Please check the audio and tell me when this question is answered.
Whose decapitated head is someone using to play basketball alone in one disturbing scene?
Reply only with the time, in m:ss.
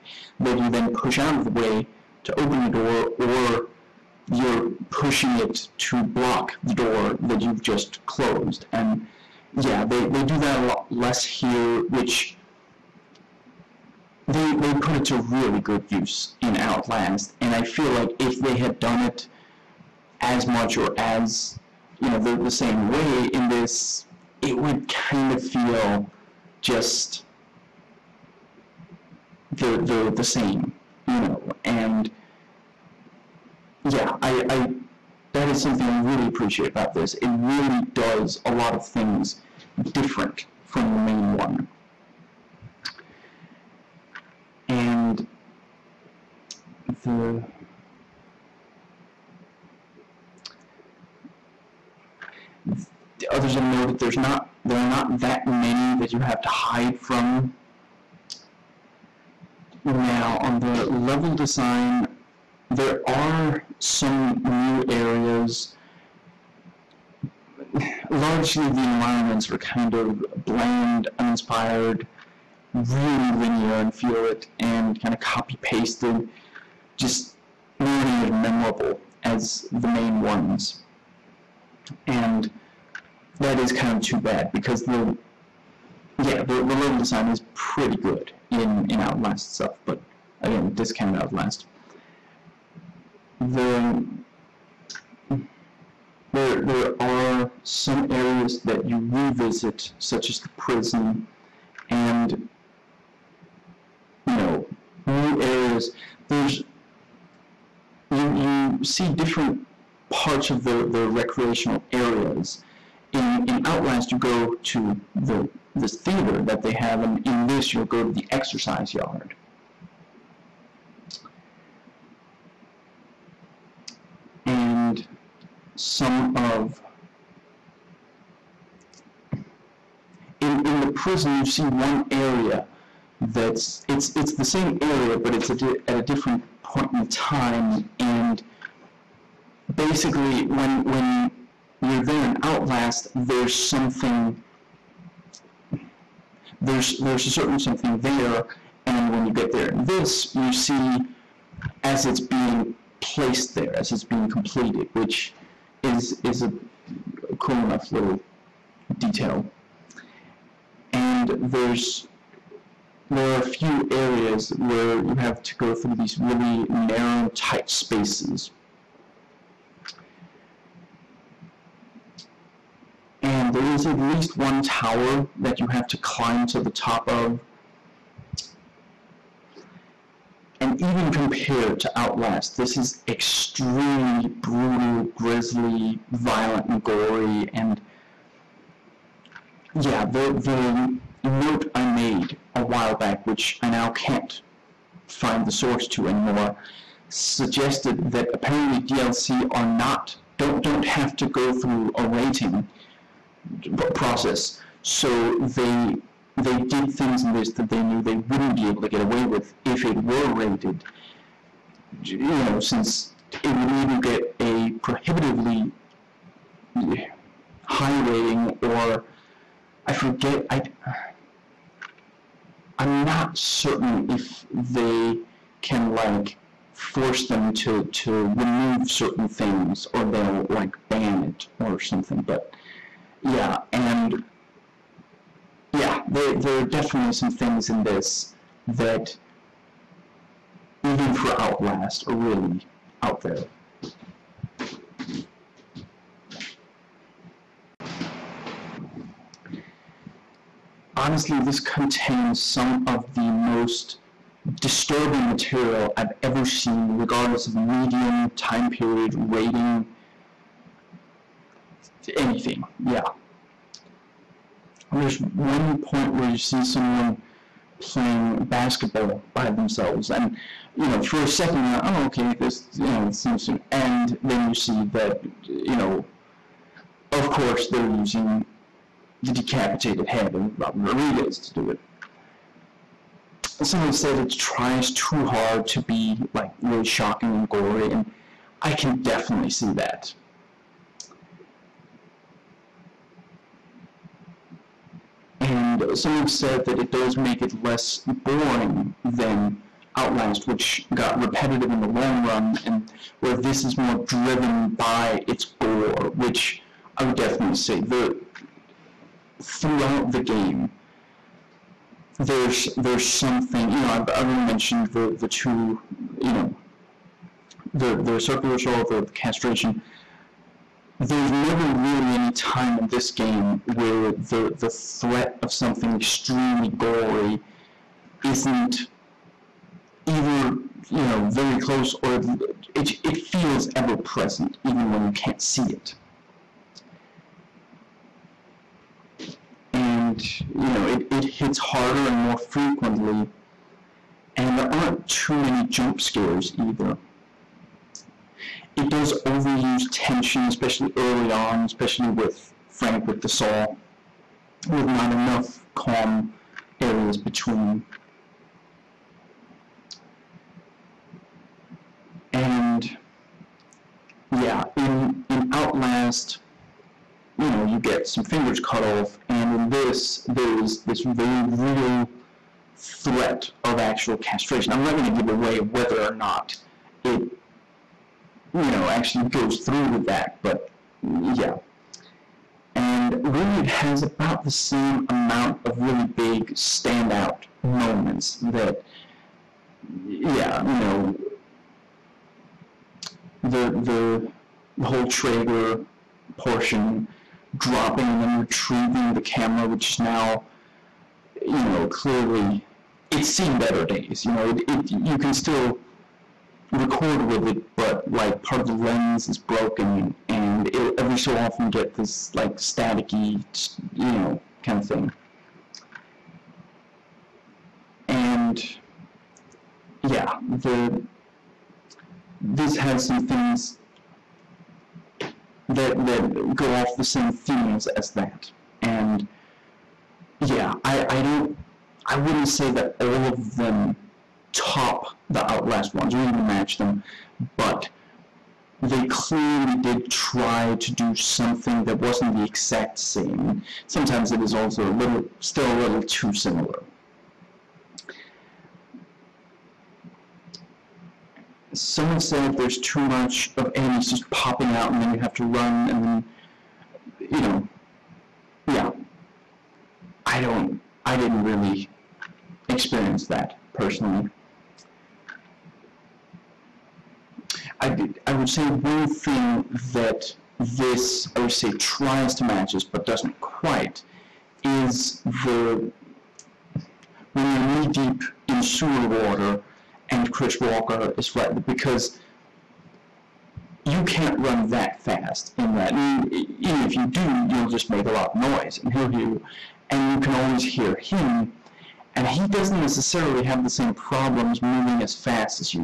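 4:40.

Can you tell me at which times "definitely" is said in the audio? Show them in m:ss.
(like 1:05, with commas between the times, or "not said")
3:56, 4:49, 5:07.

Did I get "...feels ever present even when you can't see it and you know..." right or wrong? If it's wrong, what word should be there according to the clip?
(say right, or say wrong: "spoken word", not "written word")
right.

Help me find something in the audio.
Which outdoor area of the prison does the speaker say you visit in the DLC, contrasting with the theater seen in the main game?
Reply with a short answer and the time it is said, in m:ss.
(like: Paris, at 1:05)
exercise yard, at 1:58.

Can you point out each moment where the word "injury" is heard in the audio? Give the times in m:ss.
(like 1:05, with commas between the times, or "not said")
not said.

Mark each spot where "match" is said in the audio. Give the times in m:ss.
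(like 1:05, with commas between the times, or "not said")
7:16, 7:52.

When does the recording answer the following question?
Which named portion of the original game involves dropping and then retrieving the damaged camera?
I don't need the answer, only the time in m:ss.
6:35.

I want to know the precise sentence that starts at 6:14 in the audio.
I'm not going to give away whether or not it you know, actually goes through with that, but yeah.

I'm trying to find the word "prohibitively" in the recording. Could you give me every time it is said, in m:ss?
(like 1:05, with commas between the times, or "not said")
3:34.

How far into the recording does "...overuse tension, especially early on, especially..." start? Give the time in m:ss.
5:49.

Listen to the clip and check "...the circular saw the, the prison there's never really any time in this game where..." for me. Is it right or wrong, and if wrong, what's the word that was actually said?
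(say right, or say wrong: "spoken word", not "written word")
wrong: "castration", not "prison".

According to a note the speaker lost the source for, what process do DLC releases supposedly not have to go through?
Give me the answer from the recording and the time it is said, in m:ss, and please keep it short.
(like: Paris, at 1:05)
rating process, at 3:22.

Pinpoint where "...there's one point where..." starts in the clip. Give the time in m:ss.
4:24.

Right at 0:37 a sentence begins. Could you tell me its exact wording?
It really does a lot of things different from the main one.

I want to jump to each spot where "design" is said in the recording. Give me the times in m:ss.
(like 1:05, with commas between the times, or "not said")
1:01, 1:26.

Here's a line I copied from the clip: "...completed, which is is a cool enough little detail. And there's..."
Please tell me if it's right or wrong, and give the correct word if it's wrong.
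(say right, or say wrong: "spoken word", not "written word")
right.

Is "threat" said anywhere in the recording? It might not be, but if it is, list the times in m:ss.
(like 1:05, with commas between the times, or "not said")
5:24, 6:12.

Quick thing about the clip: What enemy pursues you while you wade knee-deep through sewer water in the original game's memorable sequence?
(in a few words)
Chris Walker.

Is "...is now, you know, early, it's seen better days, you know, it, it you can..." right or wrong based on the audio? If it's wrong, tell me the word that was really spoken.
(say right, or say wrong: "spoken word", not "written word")
wrong: "clearly", not "early".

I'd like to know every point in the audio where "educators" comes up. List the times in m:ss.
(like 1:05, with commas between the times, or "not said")
not said.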